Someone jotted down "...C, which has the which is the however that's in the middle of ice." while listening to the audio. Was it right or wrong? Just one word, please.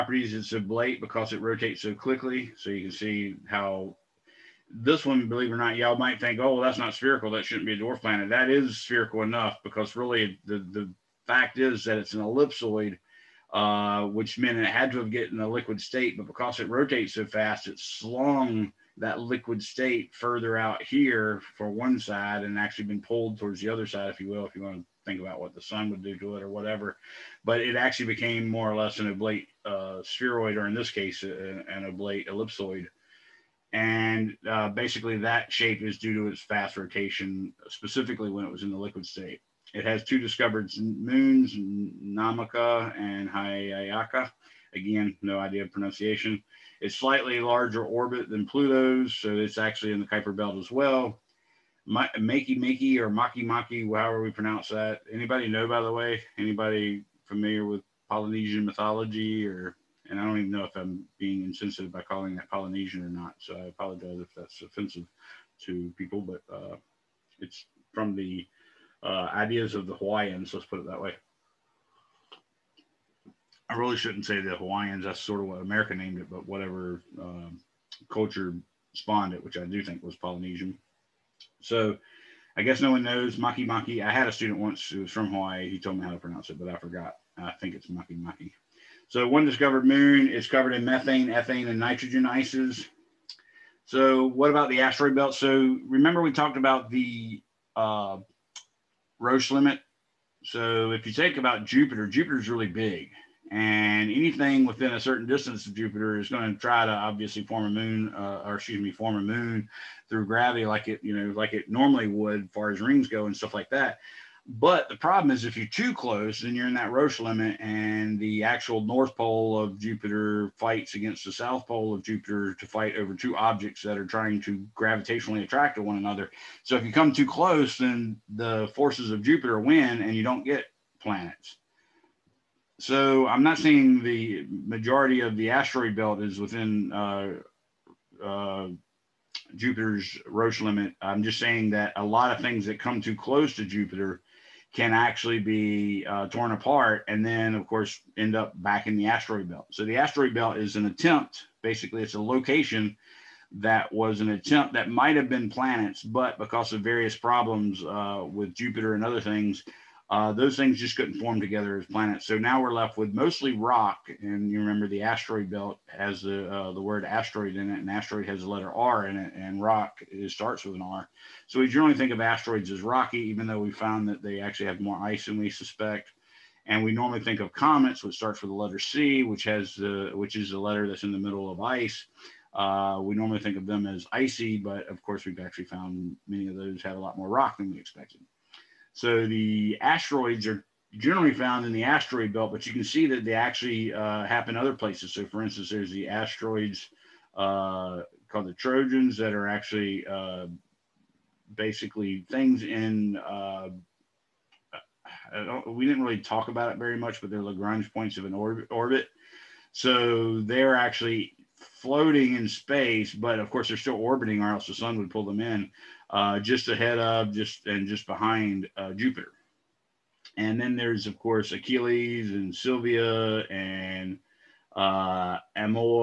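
wrong.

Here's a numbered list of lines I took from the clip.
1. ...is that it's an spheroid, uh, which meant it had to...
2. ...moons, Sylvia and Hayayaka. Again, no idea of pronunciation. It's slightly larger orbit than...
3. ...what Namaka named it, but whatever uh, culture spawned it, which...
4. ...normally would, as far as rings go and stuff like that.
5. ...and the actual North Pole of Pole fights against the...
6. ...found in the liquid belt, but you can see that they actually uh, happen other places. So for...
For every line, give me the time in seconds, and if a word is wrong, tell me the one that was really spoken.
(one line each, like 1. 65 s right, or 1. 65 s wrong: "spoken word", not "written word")
1. 11 s wrong: "ellipsoid", not "spheroid"
2. 40 s wrong: "Namaka", not "Sylvia"
3. 75 s wrong: "America", not "Namaka"
4. 111 s right
5. 117 s wrong: "Jupiter", not "Pole"
6. 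191 s wrong: "asteroid", not "liquid".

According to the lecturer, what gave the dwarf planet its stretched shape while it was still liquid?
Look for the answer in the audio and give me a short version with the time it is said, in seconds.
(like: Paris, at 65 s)
Fast rotation, at 36 s.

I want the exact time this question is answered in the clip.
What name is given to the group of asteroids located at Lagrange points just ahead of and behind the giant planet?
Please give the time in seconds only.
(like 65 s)
198 s.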